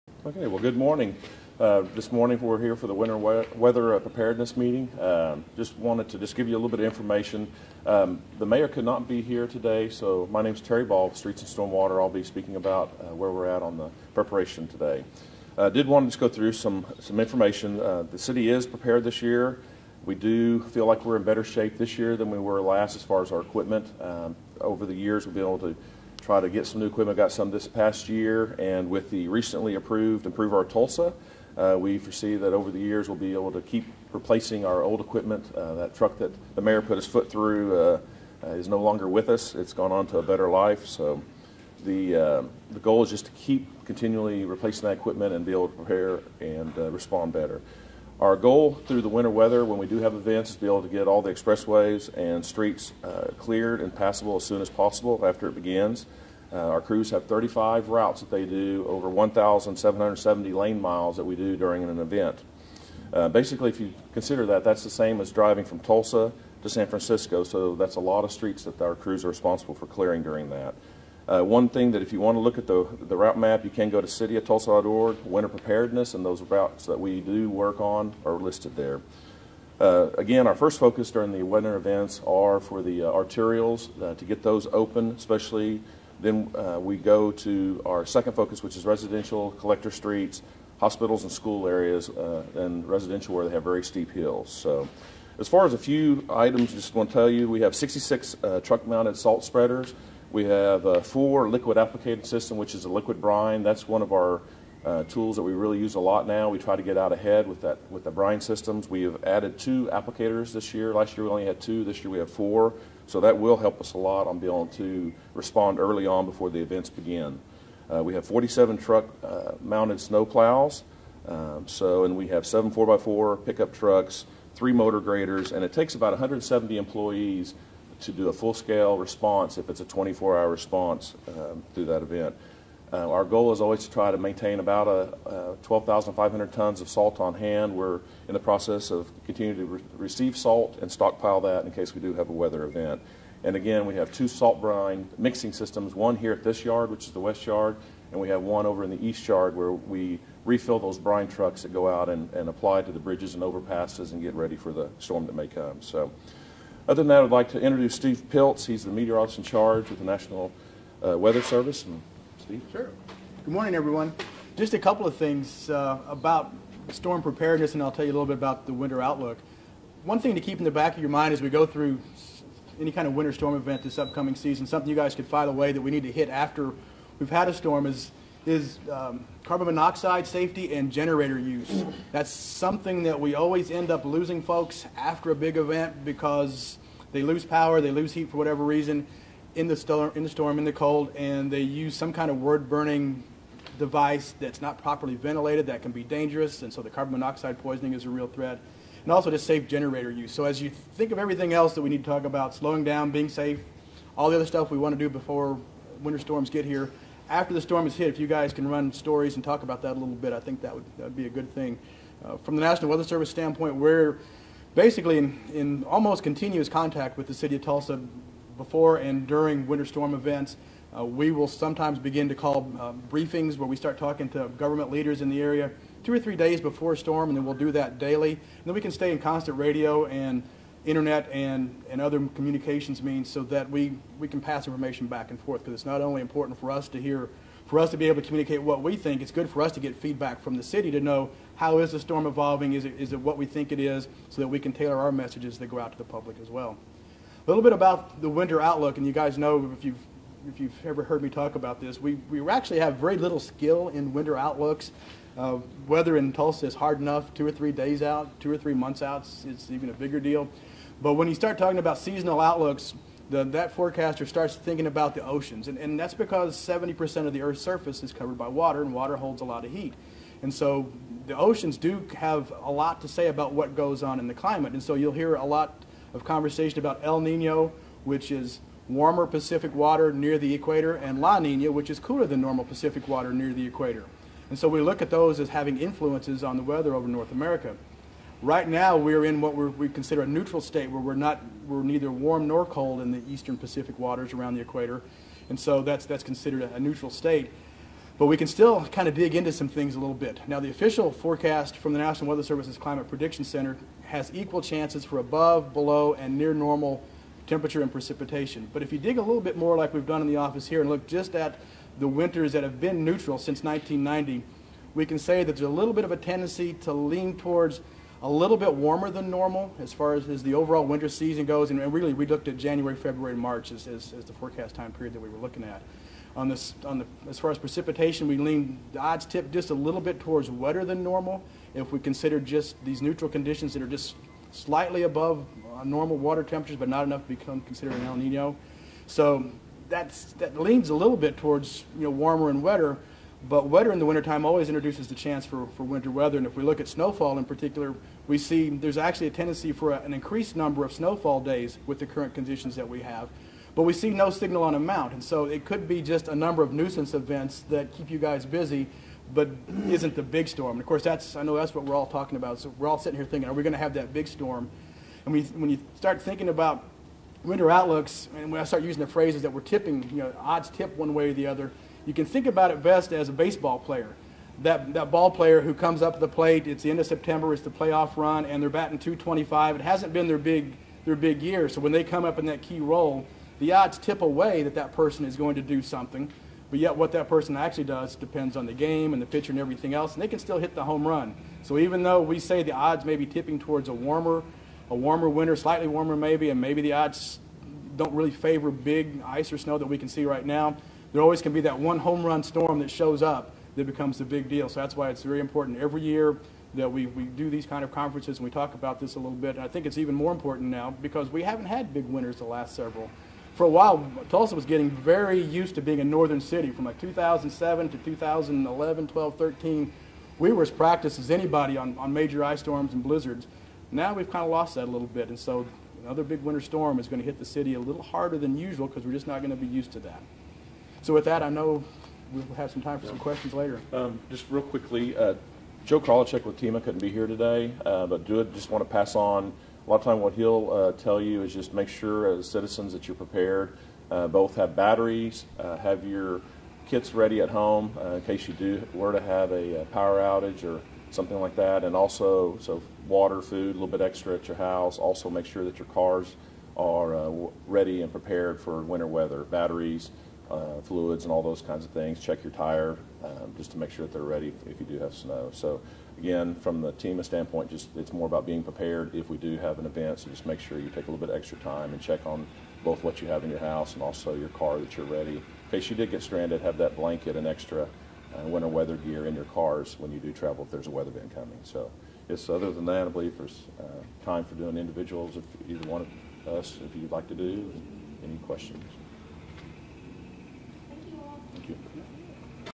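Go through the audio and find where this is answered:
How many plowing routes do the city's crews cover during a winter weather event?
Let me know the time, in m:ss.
0:57.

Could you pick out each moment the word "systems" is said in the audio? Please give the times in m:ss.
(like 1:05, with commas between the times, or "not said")
1:42, 1:48, 2:25.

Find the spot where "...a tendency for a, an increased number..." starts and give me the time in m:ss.
5:49.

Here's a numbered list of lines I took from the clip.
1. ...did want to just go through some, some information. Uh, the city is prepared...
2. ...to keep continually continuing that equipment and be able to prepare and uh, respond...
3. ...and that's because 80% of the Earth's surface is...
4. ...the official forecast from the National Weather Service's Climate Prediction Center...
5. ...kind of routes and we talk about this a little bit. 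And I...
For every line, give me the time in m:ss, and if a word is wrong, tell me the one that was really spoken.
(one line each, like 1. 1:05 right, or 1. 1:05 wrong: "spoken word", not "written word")
1. 0:15 right
2. 0:43 wrong: "replacing", not "continuing"
3. 4:25 wrong: "70", not "80"
4. 5:00 right
5. 6:47 wrong: "conferences", not "routes".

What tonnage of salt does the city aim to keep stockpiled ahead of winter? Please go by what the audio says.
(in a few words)
12,500 tons.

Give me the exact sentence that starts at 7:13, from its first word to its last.
Um, just real quickly, uh, Joe Kralicek with TEMA couldn't be here today, uh, but do it, just want to pass on.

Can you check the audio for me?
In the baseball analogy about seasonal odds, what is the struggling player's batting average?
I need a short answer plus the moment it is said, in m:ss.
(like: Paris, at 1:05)
225, at 6:18.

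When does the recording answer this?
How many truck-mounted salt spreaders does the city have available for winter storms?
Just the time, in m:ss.
1:37.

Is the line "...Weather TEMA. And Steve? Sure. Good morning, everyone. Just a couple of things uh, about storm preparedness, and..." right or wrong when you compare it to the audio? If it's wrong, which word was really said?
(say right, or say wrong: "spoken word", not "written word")
wrong: "Service", not "TEMA".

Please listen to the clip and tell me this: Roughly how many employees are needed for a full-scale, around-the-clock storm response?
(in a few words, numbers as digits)
170.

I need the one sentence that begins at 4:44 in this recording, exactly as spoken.
And so we look at those as having influences on the weather over North America.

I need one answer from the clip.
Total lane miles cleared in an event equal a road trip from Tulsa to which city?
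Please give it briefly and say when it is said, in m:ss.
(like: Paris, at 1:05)
San Francisco, at 1:06.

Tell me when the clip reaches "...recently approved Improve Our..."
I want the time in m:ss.
0:29.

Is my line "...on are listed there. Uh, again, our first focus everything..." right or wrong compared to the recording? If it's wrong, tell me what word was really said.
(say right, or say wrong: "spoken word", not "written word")
wrong: "during", not "everything".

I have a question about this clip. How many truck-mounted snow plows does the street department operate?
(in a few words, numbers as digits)
47.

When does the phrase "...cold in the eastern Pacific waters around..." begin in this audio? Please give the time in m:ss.
4:52.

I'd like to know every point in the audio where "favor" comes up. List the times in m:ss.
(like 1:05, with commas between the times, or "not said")
6:38.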